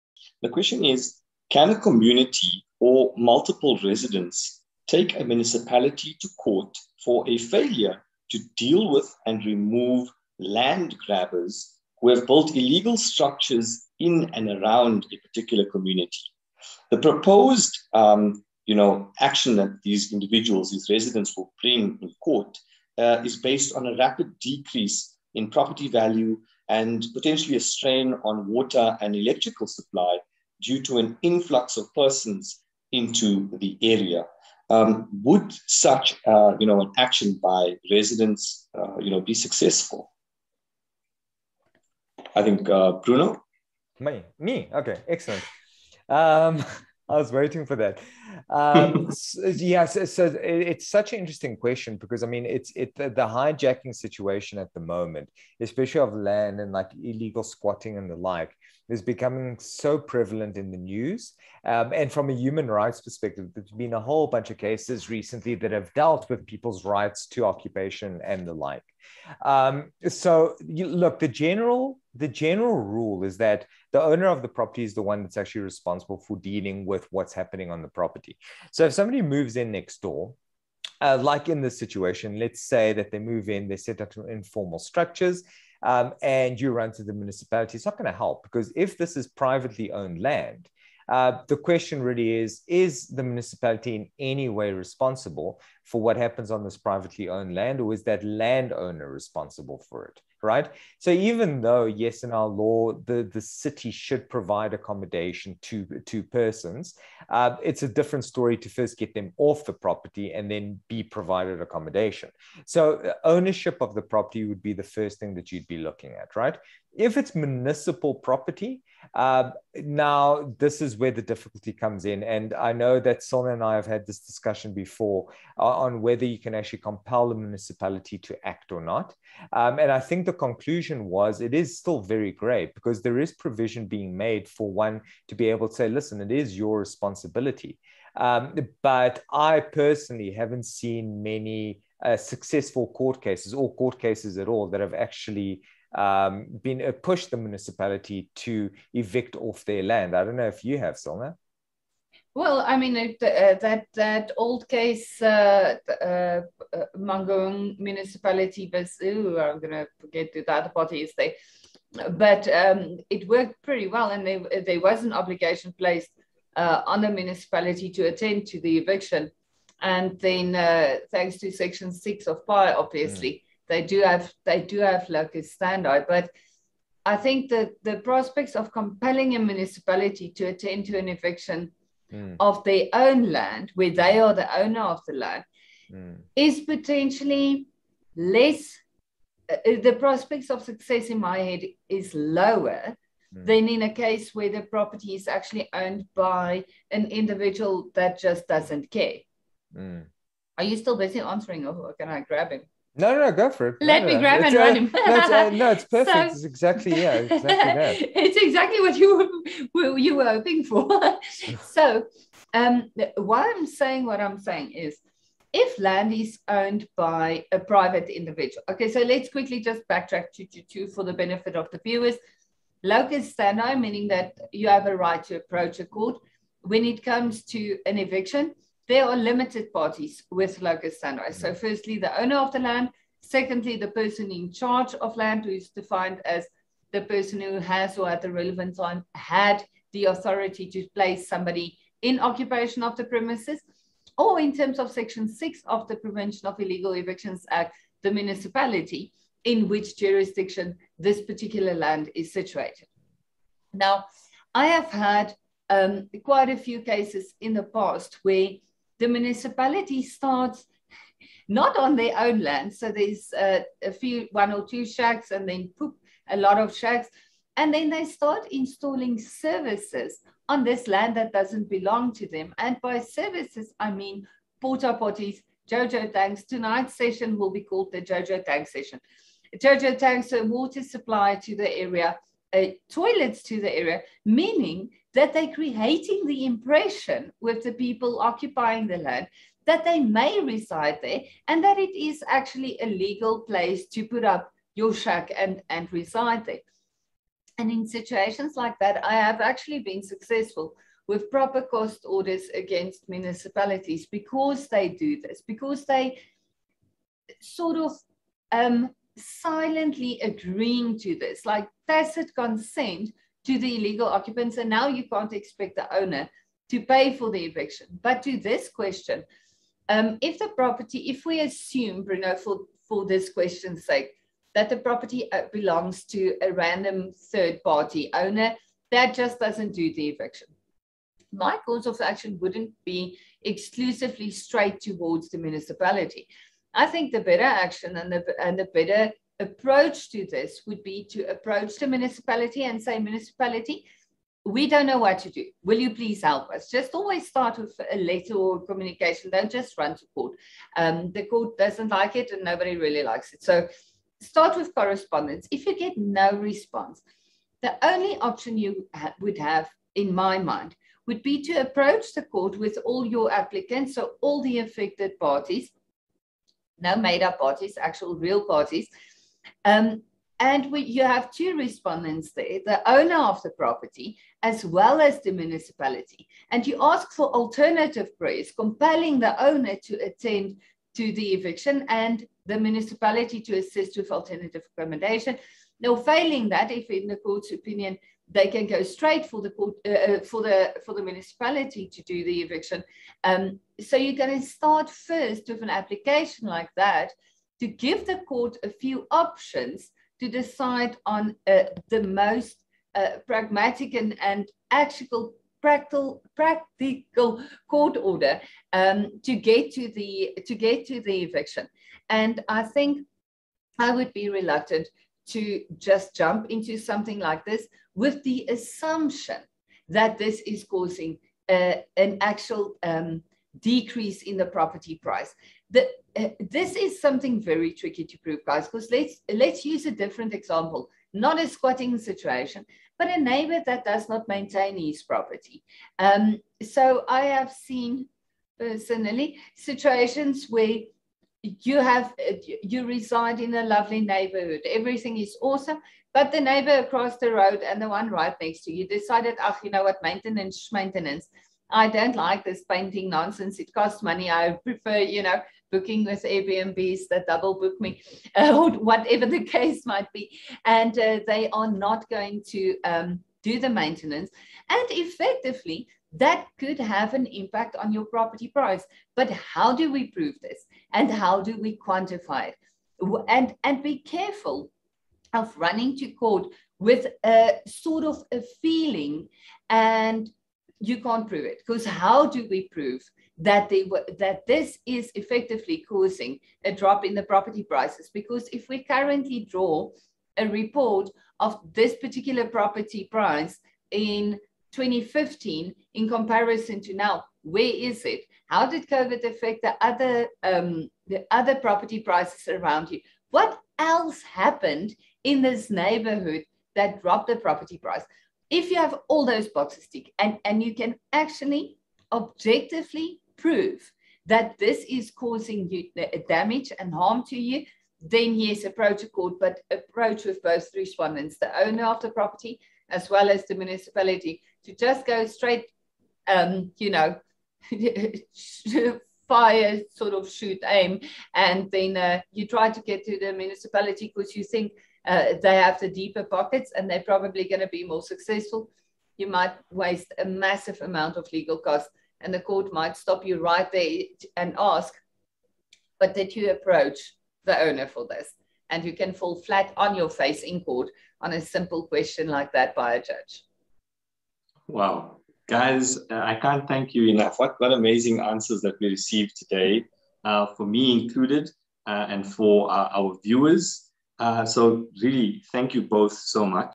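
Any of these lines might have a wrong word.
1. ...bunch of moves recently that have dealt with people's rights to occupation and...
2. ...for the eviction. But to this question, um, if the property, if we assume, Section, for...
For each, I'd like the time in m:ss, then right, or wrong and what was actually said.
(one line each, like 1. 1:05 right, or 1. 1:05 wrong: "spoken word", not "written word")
1. 1:04 wrong: "cases", not "moves"
2. 5:17 wrong: "Bruno", not "Section".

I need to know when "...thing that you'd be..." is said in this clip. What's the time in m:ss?
1:55.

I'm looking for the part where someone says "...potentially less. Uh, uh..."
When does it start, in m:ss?
3:06.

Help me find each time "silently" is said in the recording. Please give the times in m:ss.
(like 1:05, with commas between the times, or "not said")
5:09.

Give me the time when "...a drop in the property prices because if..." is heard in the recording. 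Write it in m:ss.
8:06.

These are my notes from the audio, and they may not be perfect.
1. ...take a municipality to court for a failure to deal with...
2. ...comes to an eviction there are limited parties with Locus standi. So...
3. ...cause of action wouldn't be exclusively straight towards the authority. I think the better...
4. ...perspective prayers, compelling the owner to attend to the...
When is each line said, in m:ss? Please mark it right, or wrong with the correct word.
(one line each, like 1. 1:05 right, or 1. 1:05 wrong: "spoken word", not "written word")
1. 0:04 right
2. 3:47 right
3. 5:31 wrong: "municipality", not "authority"
4. 6:17 wrong: "alternative", not "perspective".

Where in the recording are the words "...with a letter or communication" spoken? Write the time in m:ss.
5:47.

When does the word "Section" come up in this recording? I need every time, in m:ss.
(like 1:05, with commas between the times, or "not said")
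2:51, 4:04.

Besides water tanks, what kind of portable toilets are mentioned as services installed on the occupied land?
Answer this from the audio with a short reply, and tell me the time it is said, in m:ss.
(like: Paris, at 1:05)
Porta potties, at 4:34.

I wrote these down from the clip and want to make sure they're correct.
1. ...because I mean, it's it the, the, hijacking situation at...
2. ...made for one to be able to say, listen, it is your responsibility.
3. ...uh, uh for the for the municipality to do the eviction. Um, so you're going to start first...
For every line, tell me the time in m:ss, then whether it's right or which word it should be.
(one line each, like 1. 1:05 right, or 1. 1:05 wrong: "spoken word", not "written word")
1. 0:51 right
2. 2:14 right
3. 6:29 right.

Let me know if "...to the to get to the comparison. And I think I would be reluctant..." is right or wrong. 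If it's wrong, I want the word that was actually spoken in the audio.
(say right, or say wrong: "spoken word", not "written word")
wrong: "eviction", not "comparison".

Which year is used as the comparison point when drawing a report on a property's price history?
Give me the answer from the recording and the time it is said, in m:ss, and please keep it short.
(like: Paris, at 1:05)
2015, at 8:14.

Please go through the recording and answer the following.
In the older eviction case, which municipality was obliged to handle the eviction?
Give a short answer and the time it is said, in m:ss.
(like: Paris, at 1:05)
Mangaung, at 2:36.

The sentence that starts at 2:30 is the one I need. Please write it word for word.
I don't know if you have, Cilna.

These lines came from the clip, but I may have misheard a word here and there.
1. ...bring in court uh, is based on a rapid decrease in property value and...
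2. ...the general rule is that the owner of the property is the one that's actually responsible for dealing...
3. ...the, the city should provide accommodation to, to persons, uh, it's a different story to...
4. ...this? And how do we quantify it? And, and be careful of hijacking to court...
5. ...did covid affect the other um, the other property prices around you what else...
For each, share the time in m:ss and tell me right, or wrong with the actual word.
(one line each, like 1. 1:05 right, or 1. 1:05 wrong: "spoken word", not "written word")
1. 0:21 right
2. 1:12 right
3. 1:43 right
4. 7:50 wrong: "running", not "hijacking"
5. 8:18 right.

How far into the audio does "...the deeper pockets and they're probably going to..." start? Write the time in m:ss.
8:55.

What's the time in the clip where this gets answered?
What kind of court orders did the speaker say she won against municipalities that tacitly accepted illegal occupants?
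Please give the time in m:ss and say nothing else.
5:01.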